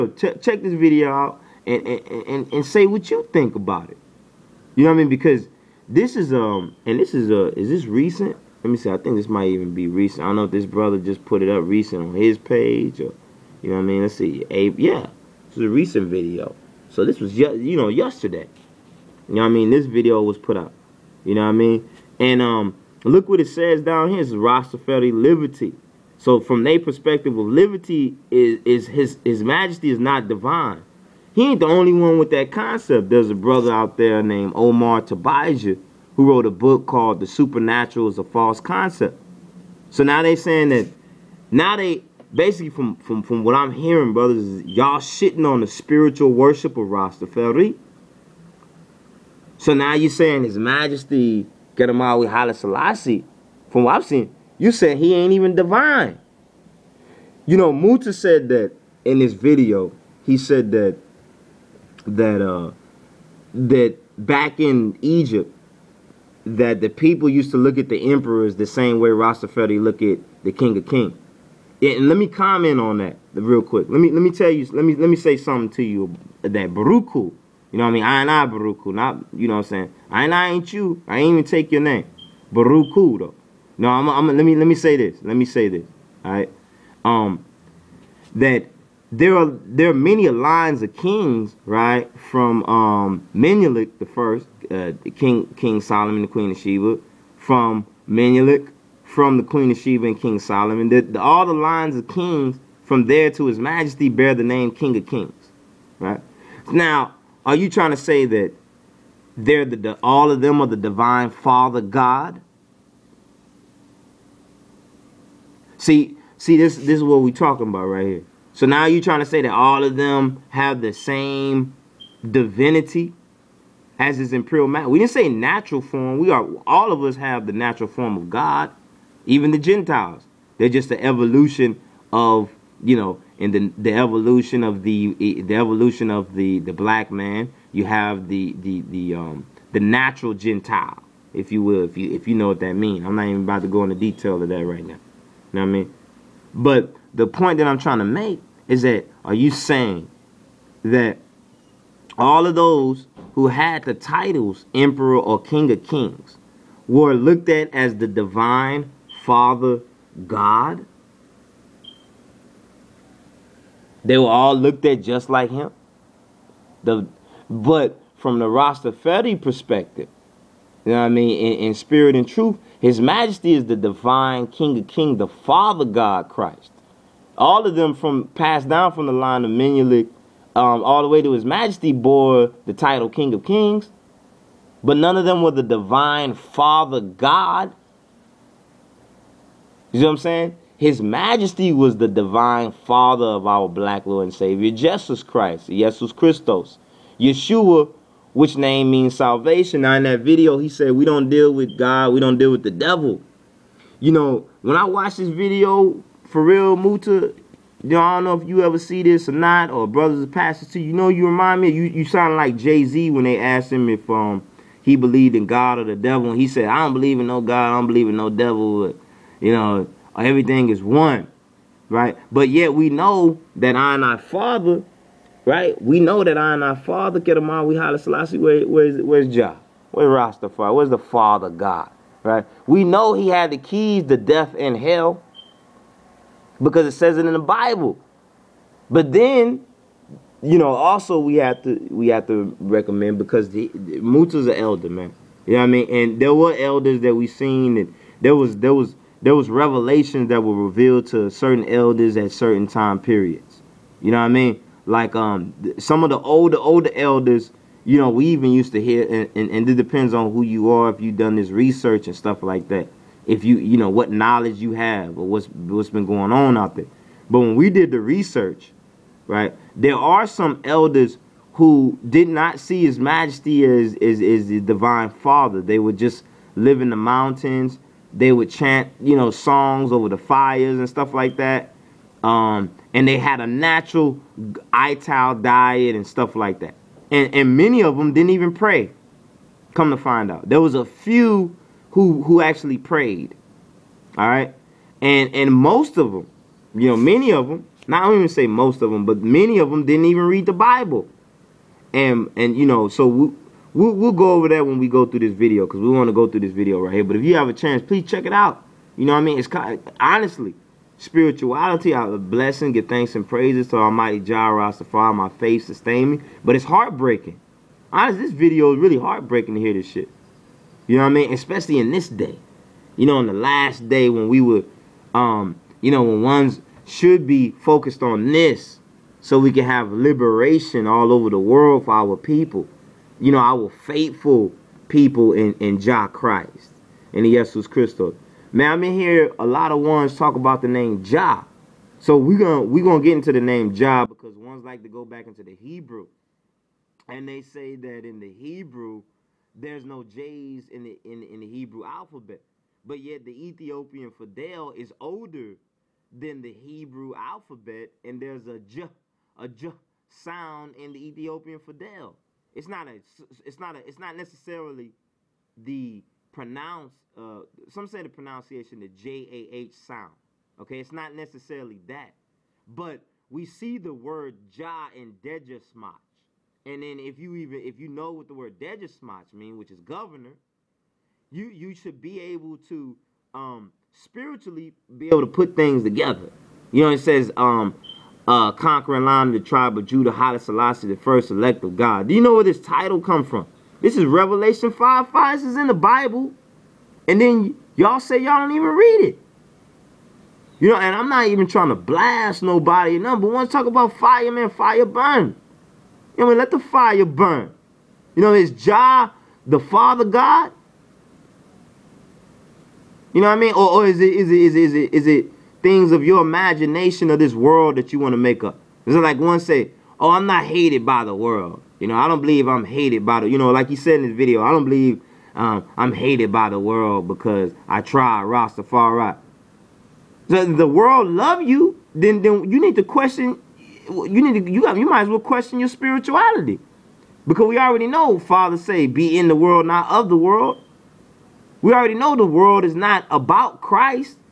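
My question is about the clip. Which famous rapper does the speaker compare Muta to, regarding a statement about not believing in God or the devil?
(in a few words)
Jay Z.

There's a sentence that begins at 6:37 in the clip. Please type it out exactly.
And then y'all say y'all don't even read it.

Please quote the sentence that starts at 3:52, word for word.
We know he had the keys to death and hell because it says it in the Bible.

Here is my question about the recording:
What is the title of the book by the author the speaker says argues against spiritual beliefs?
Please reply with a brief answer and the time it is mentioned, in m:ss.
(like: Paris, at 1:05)
The Supernatural is a False Concept, at 0:37.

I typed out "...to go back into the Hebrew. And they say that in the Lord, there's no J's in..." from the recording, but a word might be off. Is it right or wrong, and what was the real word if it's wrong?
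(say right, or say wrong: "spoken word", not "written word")
wrong: "Hebrew", not "Lord".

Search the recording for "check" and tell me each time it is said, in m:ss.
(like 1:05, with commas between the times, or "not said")
0:00, 5:08.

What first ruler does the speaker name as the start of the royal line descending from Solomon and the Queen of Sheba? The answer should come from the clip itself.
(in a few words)
Menelik the First.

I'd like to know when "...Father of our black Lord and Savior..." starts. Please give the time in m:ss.
3:12.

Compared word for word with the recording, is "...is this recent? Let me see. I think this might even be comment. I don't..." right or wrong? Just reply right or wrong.
wrong.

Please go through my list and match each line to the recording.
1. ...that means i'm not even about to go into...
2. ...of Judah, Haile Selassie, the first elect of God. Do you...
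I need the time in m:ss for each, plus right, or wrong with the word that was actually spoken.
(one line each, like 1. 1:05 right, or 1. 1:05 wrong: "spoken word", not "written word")
1. 2:22 right
2. 6:29 right.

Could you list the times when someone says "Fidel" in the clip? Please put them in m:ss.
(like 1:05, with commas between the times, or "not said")
5:54, 6:01.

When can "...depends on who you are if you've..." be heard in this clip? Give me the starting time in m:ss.
4:19.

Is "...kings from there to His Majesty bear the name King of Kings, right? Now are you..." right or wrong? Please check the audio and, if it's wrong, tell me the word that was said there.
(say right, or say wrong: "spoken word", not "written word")
right.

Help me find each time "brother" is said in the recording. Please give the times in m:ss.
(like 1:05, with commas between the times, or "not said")
0:10, 0:33, 0:44, 3:29.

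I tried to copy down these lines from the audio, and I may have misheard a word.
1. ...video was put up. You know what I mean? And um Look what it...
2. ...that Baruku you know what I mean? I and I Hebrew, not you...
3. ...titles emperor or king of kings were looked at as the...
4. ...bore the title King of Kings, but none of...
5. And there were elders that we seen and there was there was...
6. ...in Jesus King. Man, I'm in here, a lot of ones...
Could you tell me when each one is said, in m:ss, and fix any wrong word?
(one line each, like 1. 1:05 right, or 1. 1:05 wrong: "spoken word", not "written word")
1. 0:19 right
2. 1:16 wrong: "Baruku", not "Hebrew"
3. 2:33 right
4. 3:01 right
5. 4:05 right
6. 5:37 wrong: "Christos", not "King".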